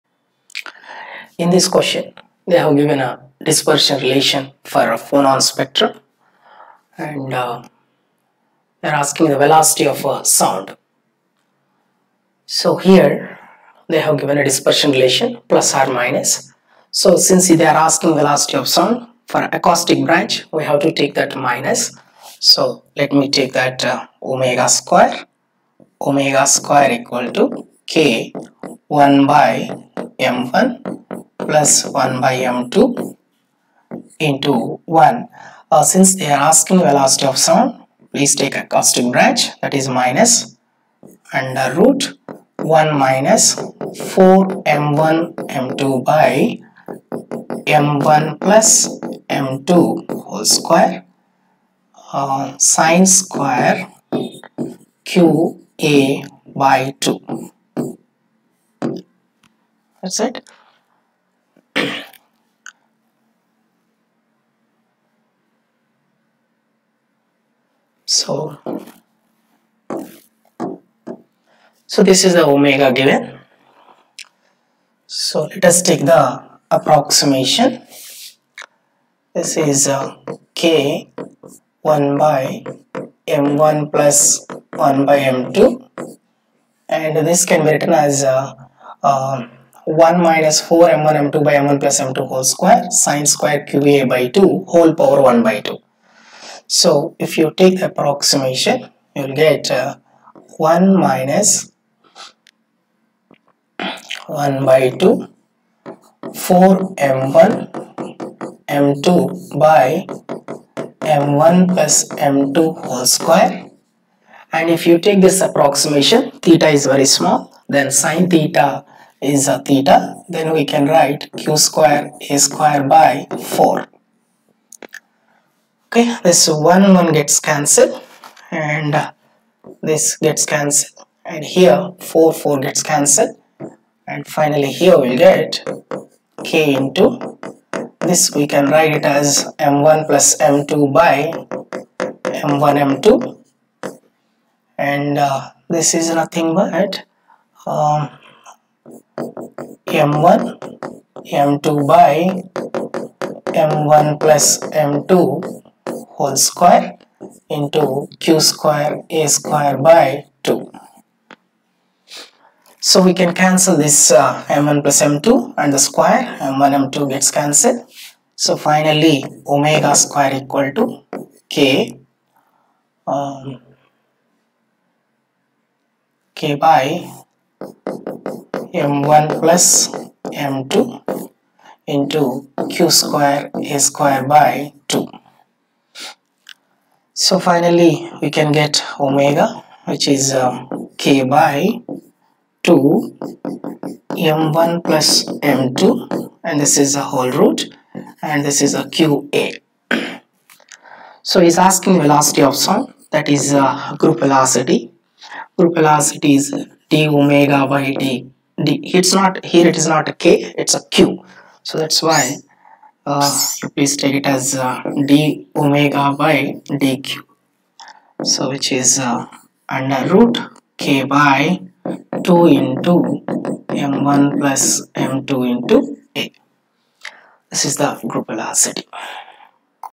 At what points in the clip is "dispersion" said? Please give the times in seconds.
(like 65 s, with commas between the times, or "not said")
3 s, 14 s.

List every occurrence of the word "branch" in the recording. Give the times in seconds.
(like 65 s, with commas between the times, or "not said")
20 s, 39 s.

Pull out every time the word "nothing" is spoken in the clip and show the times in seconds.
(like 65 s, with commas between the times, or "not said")
146 s.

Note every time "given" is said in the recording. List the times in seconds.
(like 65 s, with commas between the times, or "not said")
2 s, 14 s, 72 s.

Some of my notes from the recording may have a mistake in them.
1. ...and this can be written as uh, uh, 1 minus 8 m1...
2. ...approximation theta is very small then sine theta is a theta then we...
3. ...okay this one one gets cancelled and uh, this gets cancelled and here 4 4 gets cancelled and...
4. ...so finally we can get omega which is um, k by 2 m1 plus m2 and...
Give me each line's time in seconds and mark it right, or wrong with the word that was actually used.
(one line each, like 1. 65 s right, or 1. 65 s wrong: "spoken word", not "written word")
1. 86 s wrong: "4", not "8"
2. 115 s right
3. 125 s right
4. 187 s right.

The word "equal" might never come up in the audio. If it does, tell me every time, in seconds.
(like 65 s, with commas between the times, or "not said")
26 s, 170 s.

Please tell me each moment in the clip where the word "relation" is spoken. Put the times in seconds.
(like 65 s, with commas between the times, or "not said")
4 s, 14 s.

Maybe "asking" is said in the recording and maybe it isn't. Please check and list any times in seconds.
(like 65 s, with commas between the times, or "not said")
8 s, 17 s, 36 s, 201 s.